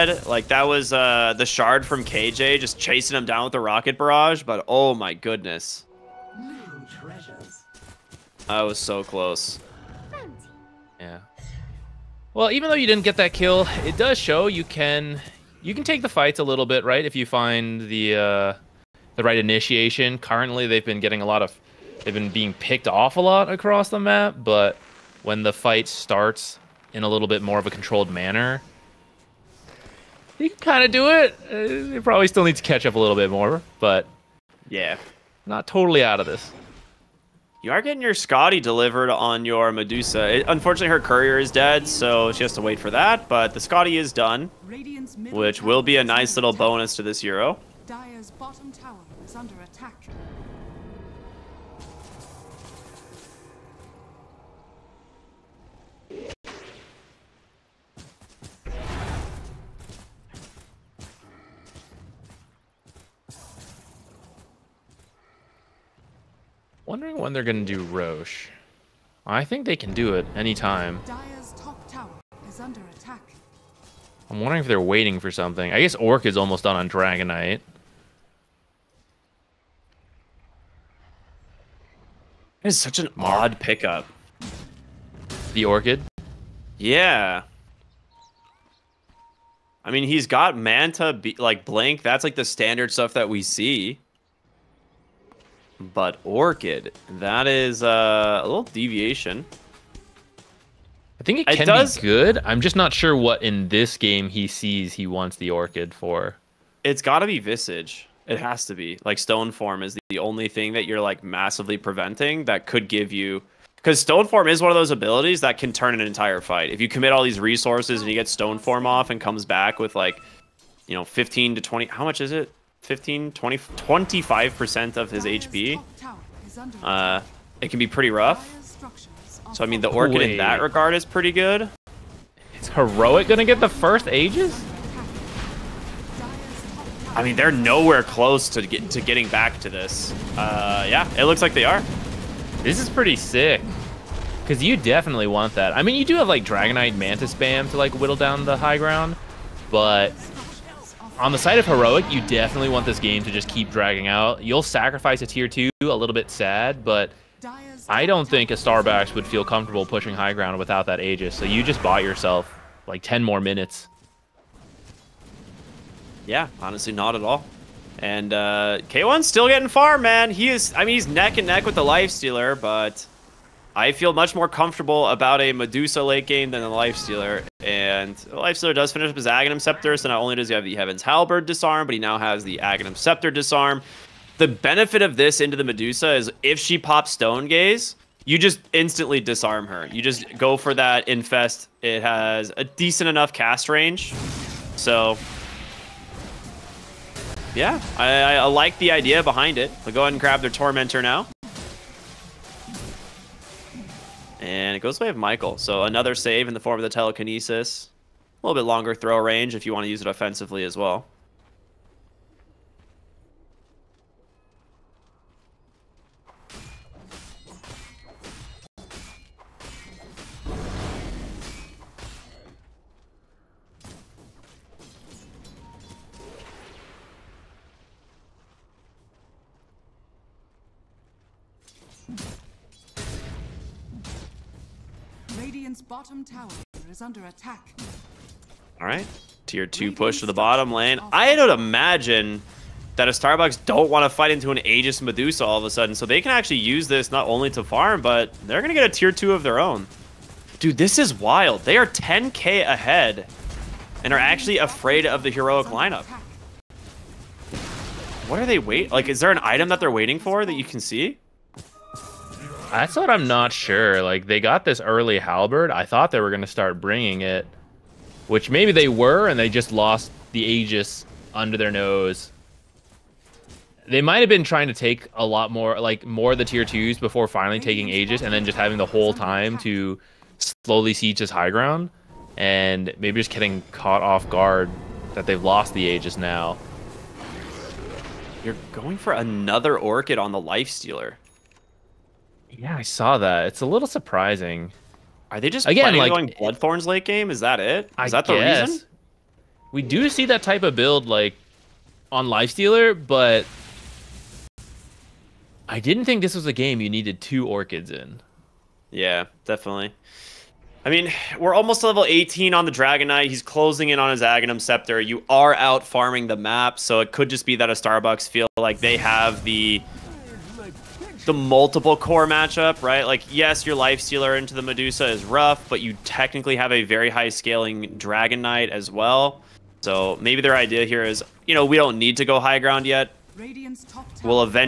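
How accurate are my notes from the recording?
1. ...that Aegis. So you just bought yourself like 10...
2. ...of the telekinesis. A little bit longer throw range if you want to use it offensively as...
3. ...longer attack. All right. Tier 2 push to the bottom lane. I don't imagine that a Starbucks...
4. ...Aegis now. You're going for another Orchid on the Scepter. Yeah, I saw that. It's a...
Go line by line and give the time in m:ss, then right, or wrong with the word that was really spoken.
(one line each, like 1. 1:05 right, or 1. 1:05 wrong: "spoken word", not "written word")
1. 2:40 right
2. 3:26 right
3. 3:57 wrong: "under", not "longer"
4. 4:45 wrong: "Lifestealer", not "Scepter".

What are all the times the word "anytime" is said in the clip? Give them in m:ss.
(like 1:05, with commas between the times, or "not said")
1:10.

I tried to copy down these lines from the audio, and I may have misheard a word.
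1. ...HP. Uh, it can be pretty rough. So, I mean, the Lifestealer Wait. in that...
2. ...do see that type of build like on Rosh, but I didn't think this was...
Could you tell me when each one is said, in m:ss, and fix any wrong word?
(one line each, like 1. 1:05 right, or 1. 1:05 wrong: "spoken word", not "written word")
1. 2:05 wrong: "Orchid", not "Lifestealer"
2. 4:59 wrong: "Lifestealer", not "Rosh".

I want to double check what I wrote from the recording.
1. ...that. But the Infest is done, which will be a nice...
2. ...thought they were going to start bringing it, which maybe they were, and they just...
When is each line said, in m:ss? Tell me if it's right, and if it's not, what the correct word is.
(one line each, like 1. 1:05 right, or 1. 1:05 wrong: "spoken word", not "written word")
1. 0:42 wrong: "Skadi", not "Infest"
2. 4:25 right.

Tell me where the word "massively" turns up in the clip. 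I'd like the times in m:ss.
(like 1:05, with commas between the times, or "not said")
1:51.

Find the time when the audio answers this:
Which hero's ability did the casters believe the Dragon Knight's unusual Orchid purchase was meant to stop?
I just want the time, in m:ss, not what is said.
1:47.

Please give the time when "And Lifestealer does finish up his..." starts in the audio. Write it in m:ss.
2:57.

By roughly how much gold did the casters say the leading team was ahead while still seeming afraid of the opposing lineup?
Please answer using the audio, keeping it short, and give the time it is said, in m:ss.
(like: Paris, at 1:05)
10k, at 4:11.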